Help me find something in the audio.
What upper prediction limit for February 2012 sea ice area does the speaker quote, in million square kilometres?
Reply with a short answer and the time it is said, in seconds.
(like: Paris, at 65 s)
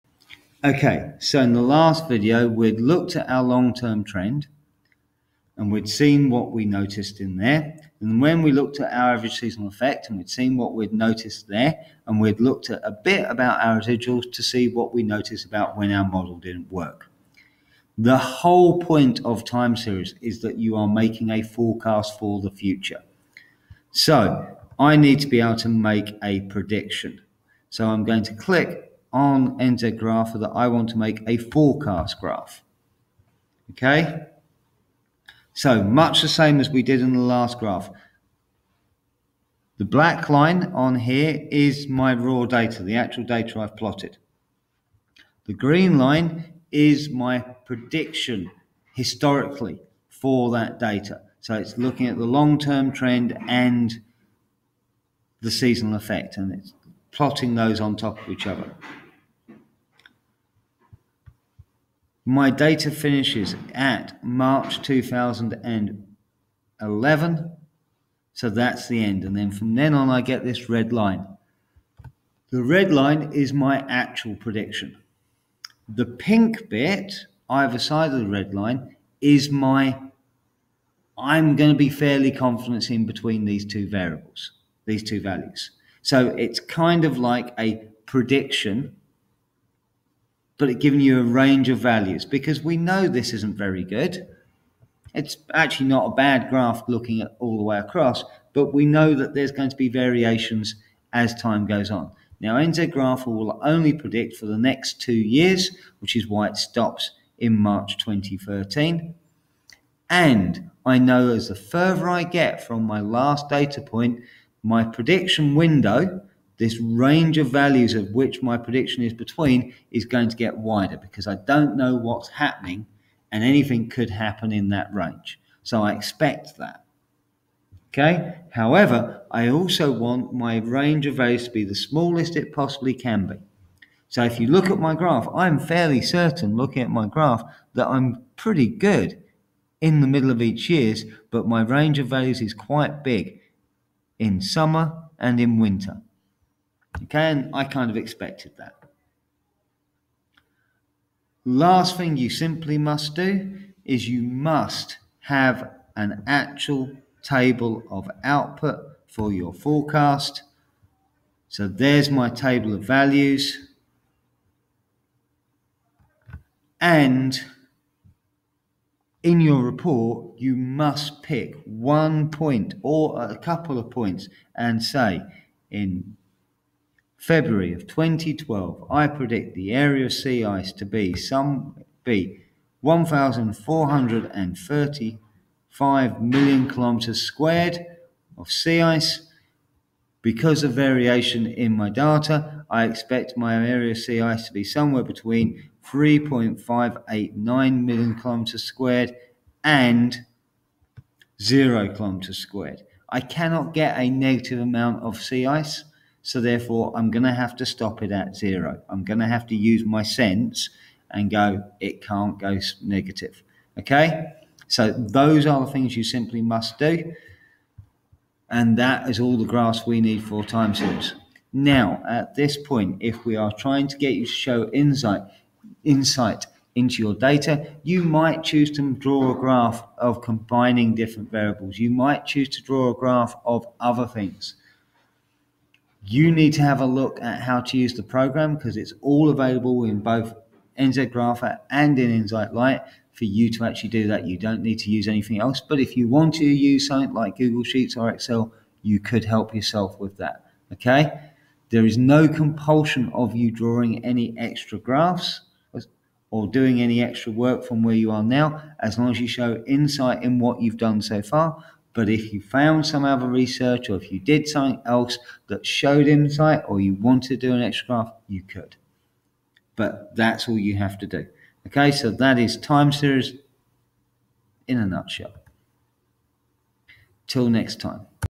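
3.589, at 195 s.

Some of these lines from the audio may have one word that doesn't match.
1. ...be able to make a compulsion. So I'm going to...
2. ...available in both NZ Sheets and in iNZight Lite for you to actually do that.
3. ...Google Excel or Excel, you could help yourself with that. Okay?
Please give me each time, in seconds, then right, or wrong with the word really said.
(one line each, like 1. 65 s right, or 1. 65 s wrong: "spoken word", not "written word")
1. 25 s wrong: "prediction", not "compulsion"
2. 239 s wrong: "Grapher", not "Sheets"
3. 247 s wrong: "Sheets", not "Excel".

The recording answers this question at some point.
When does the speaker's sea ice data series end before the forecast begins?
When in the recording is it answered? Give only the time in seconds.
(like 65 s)
64 s.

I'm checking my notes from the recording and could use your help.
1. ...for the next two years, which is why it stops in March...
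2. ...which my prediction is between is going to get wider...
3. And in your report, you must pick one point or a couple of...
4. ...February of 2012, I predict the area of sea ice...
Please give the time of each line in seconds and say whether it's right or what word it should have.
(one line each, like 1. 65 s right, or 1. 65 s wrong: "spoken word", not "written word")
1. 104 s right
2. 118 s right
3. 166 s right
4. 177 s right.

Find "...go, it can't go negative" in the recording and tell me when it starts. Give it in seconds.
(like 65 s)
211 s.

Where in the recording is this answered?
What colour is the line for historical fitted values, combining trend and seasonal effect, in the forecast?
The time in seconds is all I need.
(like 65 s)
45 s.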